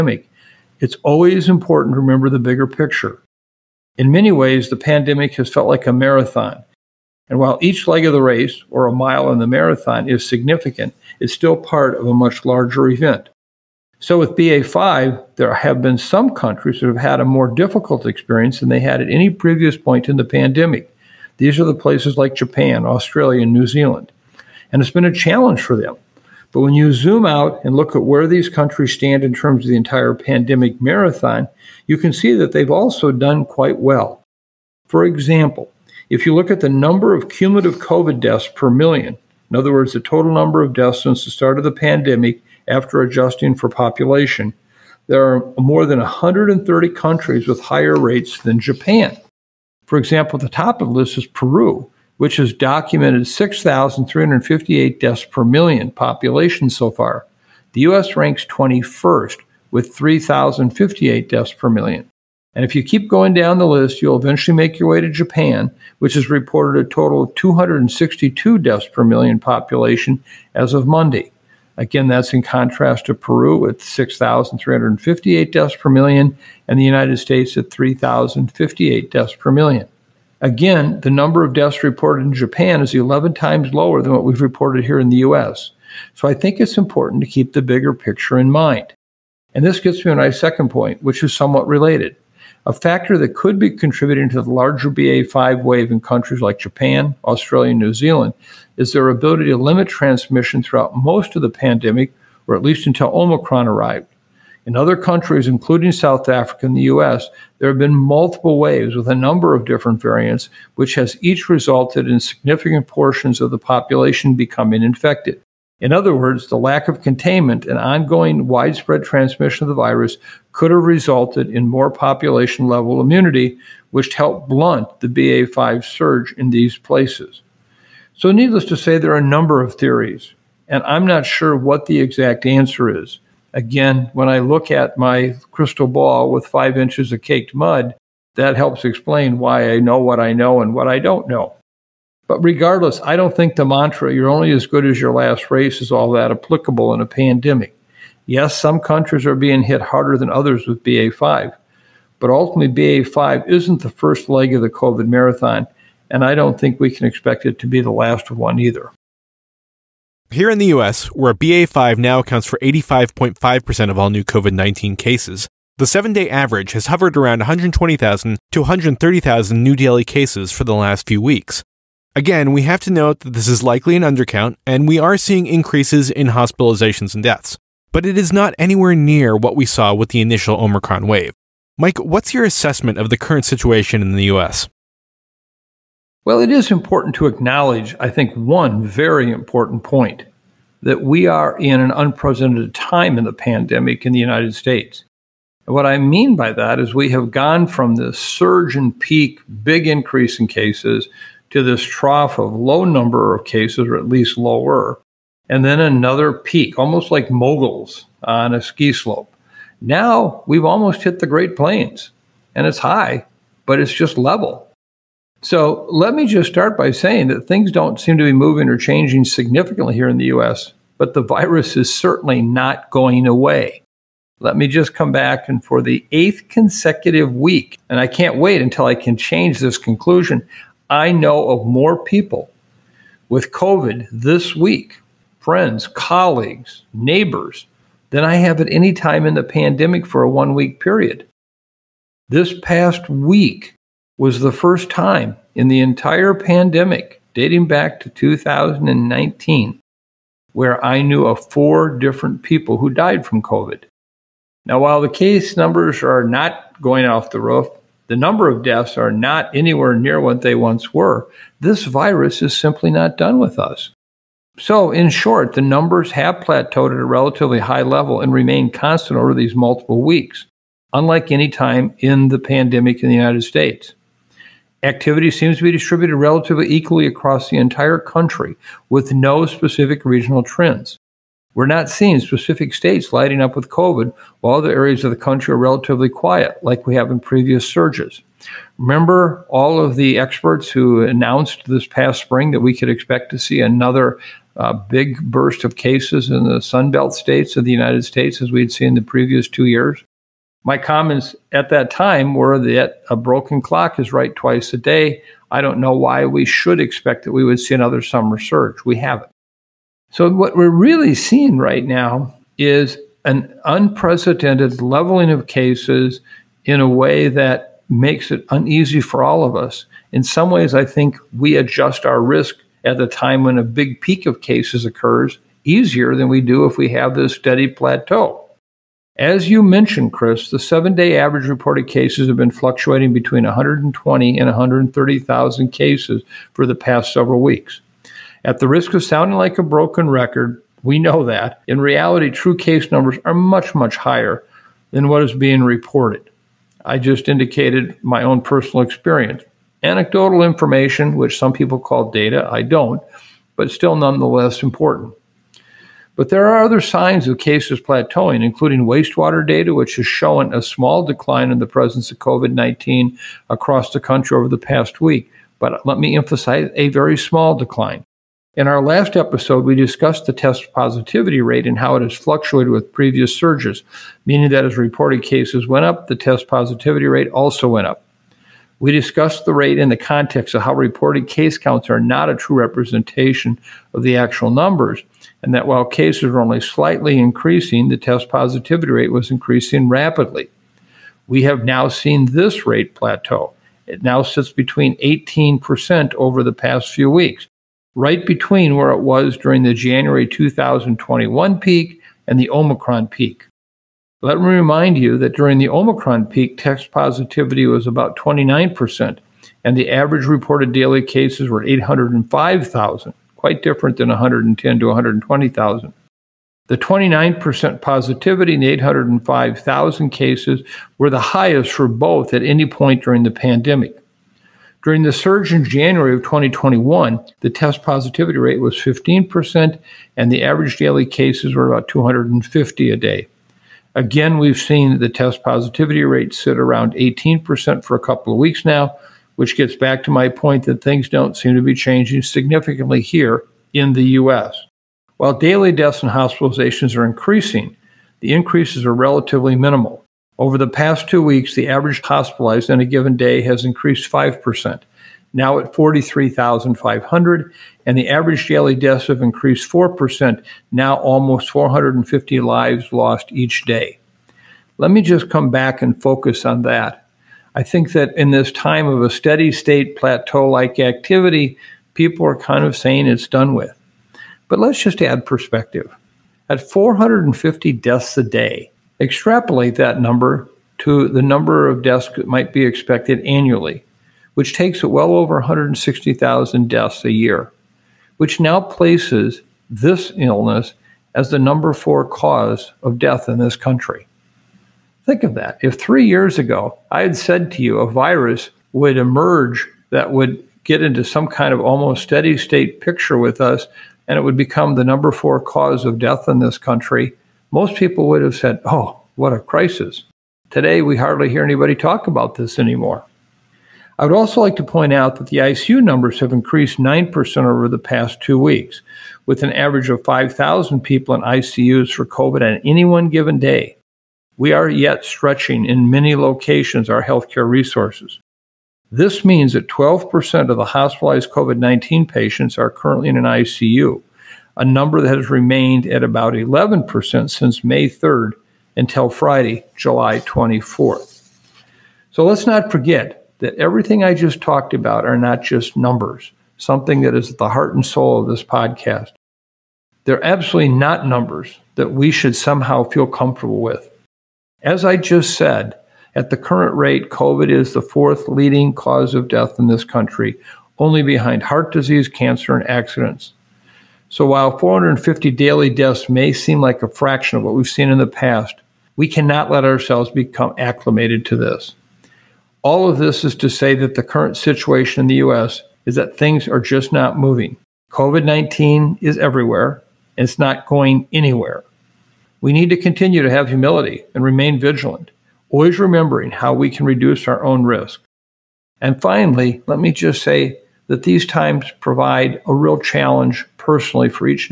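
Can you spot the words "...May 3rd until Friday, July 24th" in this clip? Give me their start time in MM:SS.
08:57.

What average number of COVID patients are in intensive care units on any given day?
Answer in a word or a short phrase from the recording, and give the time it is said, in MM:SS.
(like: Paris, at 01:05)
5,000, at 08:40.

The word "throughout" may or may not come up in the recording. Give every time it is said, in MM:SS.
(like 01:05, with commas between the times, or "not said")
01:40.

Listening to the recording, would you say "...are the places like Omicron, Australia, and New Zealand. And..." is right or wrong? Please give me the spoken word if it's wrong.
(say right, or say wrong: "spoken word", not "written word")
wrong: "Japan", not "Omicron".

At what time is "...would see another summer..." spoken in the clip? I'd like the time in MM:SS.
05:07.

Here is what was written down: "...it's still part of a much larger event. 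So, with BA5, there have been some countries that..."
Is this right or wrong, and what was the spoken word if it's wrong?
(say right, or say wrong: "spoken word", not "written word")
right.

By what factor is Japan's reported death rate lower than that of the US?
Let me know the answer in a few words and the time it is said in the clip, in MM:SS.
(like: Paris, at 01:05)
11 times, at 01:22.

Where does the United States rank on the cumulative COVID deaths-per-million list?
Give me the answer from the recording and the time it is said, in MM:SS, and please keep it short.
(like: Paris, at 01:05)
21st, at 00:58.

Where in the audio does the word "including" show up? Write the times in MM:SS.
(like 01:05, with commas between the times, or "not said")
01:45, 05:58.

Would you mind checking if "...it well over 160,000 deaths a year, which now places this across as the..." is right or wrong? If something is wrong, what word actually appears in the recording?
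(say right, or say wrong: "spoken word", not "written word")
wrong: "illness", not "across".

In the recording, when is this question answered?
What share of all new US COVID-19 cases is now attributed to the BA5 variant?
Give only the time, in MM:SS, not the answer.
02:42.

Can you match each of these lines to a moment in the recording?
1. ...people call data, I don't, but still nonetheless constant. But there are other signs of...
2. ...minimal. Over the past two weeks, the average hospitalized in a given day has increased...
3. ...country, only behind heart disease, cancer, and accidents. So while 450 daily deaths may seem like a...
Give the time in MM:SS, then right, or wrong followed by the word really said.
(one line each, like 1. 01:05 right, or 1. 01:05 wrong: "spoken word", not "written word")
1. 05:51 wrong: "important", not "constant"
2. 07:29 right
3. 09:19 right.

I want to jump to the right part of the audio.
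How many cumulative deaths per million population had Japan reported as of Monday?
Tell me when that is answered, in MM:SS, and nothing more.
01:07.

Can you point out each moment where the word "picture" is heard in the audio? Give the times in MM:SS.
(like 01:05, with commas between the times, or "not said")
00:02, 01:27, 08:22.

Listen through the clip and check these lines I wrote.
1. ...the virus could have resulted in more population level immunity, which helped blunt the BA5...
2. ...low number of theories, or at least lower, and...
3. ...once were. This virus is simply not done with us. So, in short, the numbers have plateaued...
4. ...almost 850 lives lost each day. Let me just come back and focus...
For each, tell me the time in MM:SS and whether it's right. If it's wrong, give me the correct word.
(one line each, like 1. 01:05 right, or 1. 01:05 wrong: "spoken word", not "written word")
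1. 01:59 right
2. 03:22 wrong: "cases", not "theories"
3. 04:20 right
4. 07:40 wrong: "450", not "850".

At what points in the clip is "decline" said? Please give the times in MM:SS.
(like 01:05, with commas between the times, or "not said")
06:01, 06:07.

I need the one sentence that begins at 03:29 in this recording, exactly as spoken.
Now we've almost hit the Great Plains and it's high, but it's just level.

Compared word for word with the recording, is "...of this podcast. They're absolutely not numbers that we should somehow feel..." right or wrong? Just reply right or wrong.
right.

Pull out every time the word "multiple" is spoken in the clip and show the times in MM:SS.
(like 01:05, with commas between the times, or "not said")
01:47, 04:29.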